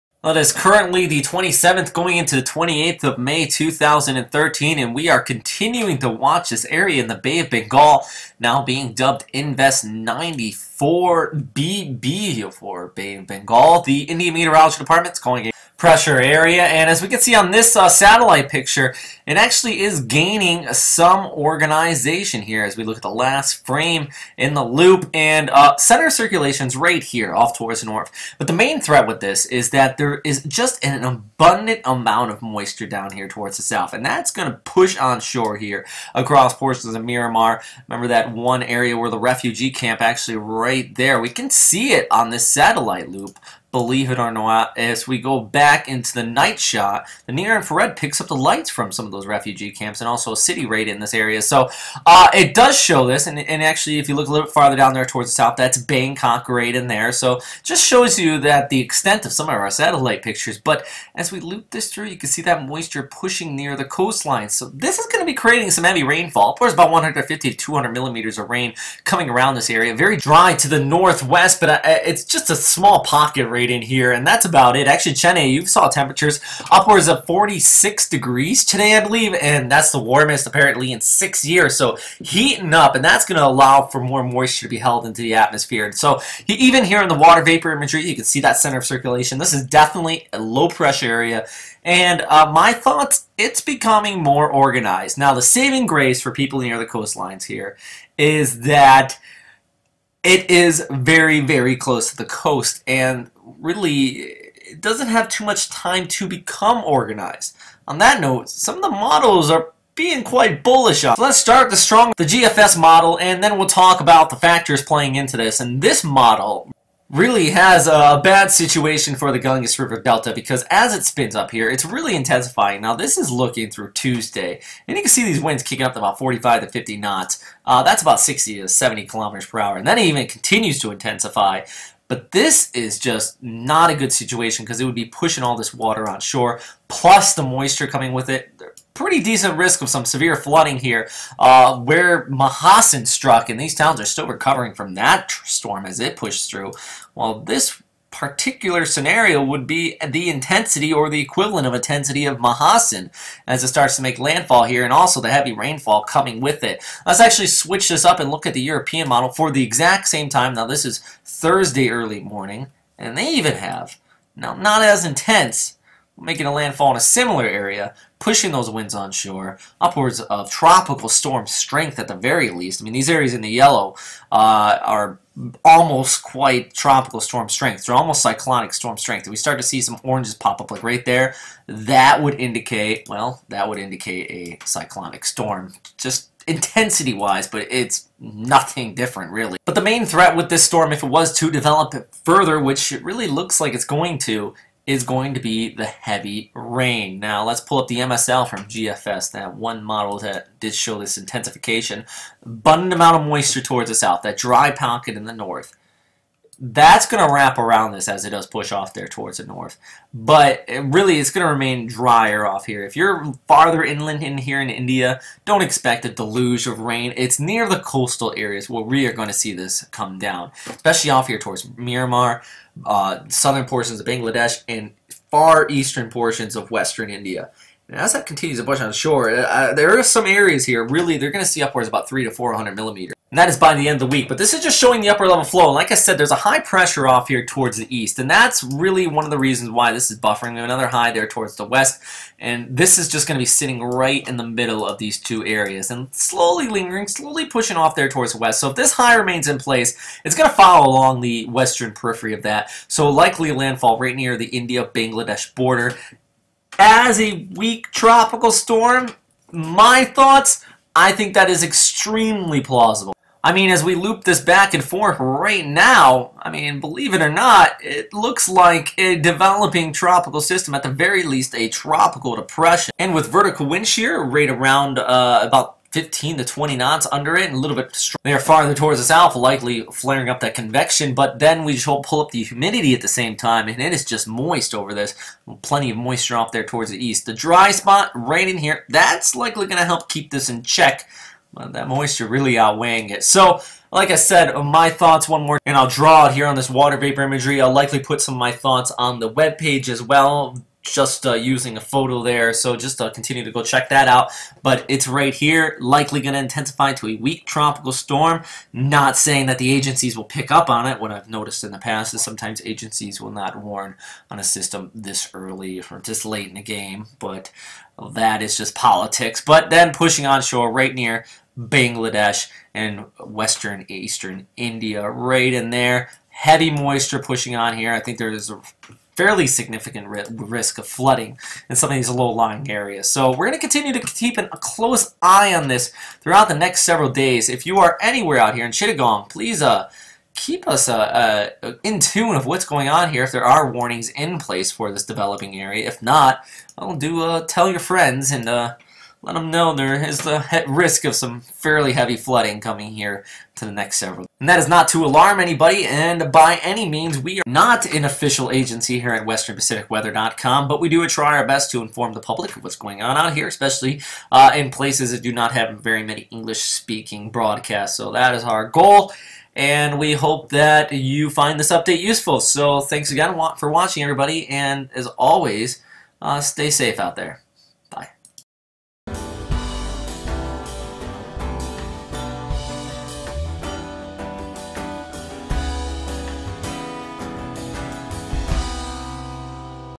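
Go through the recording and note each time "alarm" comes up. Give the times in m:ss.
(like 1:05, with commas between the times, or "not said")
5:55.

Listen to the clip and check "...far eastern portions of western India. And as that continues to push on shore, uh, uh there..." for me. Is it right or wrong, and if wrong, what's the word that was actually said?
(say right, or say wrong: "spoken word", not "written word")
right.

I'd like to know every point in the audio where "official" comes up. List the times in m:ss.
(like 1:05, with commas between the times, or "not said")
5:58.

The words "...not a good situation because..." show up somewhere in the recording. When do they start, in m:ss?
2:13.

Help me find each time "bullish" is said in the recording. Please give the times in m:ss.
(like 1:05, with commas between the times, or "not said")
1:50.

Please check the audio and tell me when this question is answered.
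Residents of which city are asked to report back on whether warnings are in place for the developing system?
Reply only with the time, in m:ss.
5:38.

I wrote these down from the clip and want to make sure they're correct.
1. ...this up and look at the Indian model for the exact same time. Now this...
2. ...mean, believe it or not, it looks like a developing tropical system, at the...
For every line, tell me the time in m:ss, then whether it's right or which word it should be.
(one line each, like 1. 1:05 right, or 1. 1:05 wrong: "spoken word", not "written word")
1. 2:37 wrong: "European", not "Indian"
2. 4:26 right.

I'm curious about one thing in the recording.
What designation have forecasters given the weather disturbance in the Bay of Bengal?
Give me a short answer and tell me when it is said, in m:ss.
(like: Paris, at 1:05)
Invest 94BB, at 0:09.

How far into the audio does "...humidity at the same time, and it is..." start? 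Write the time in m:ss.
4:42.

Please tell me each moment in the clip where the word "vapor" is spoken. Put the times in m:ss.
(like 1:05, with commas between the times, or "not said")
1:27, 4:56.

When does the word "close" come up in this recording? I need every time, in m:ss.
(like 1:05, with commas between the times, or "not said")
1:41, 5:34.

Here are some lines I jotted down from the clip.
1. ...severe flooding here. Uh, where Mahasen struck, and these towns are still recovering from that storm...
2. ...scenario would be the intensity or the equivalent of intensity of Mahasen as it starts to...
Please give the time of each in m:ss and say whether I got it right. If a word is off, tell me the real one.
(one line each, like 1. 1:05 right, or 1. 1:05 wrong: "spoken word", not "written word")
1. 2:20 right
2. 2:28 right.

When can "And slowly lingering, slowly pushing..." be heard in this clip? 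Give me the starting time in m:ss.
4:05.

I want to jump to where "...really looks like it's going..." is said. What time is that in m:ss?
3:13.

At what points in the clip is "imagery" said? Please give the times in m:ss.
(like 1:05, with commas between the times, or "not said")
1:27, 4:57.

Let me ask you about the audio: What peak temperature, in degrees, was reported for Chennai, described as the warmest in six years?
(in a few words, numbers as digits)
46.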